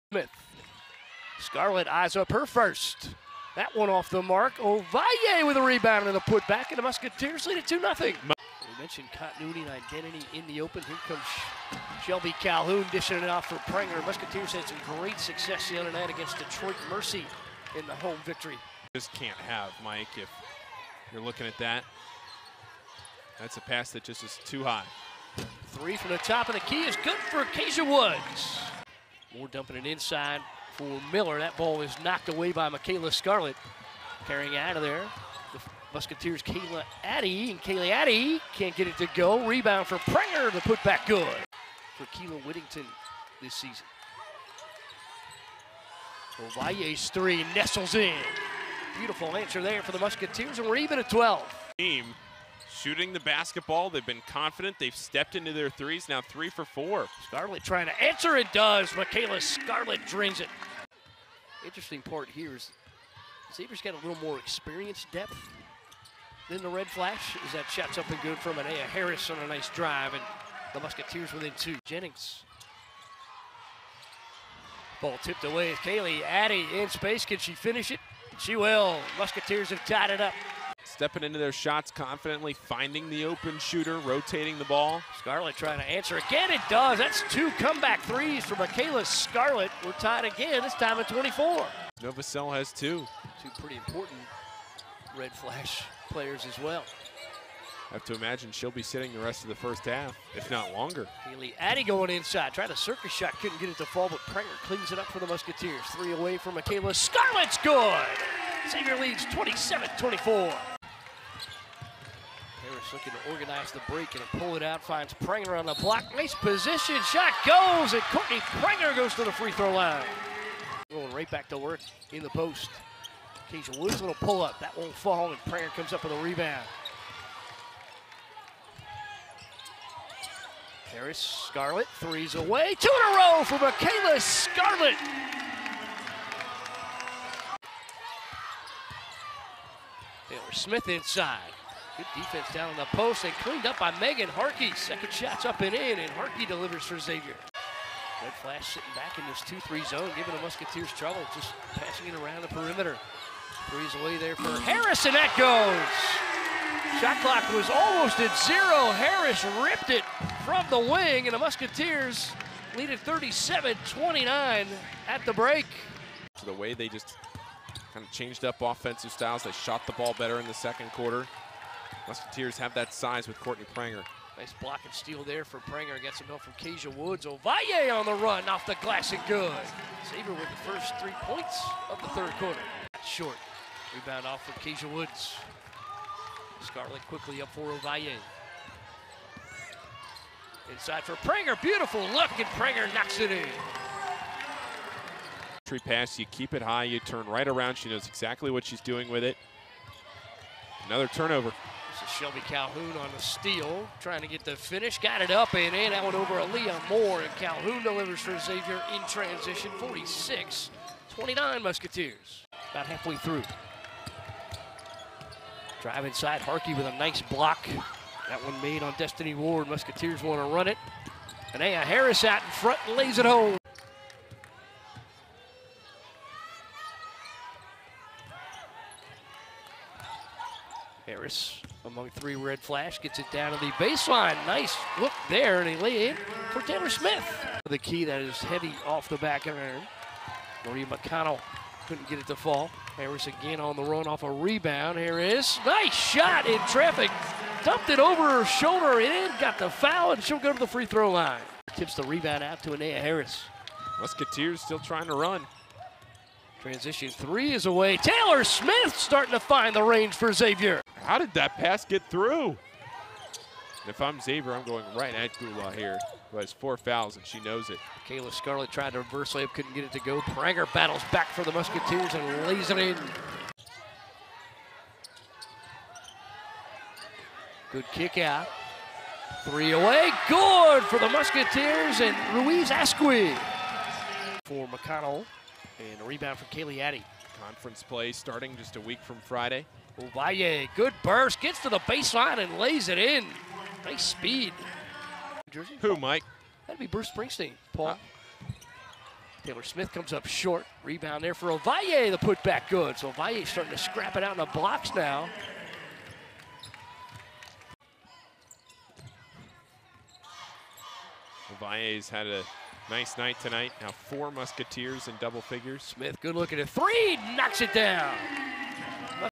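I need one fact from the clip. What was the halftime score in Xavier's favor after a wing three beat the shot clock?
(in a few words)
37-29.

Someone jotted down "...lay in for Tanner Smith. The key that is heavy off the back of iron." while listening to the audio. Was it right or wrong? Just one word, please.
right.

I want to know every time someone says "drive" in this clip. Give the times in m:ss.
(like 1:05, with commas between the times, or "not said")
1:09, 3:35.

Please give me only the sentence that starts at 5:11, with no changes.
Ovalle's had a Nice night tonight.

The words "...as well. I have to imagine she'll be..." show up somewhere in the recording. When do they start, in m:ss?
1:36.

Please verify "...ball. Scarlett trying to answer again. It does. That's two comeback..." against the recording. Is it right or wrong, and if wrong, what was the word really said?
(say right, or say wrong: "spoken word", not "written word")
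right.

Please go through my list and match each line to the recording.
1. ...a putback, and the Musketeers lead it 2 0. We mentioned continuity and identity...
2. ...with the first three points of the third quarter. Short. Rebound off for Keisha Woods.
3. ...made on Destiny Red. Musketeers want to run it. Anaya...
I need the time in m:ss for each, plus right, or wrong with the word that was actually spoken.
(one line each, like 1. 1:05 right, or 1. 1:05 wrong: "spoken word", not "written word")
1. 0:06 right
2. 3:00 right
3. 3:38 wrong: "Ward", not "Red".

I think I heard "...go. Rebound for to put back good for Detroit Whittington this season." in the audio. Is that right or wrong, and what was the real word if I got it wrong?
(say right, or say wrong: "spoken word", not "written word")
wrong: "Keela", not "Detroit".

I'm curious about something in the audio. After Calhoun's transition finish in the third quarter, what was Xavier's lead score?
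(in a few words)
46-29.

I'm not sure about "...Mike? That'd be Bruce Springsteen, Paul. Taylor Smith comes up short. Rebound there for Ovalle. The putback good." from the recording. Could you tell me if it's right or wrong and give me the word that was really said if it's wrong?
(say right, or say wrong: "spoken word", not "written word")
right.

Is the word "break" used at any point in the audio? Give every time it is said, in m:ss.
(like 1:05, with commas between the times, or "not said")
1:53, 2:45.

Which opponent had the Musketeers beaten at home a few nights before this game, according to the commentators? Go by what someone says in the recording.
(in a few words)
Detroit Mercy.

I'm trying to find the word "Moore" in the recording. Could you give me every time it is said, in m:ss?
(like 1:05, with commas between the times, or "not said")
0:29, 3:26.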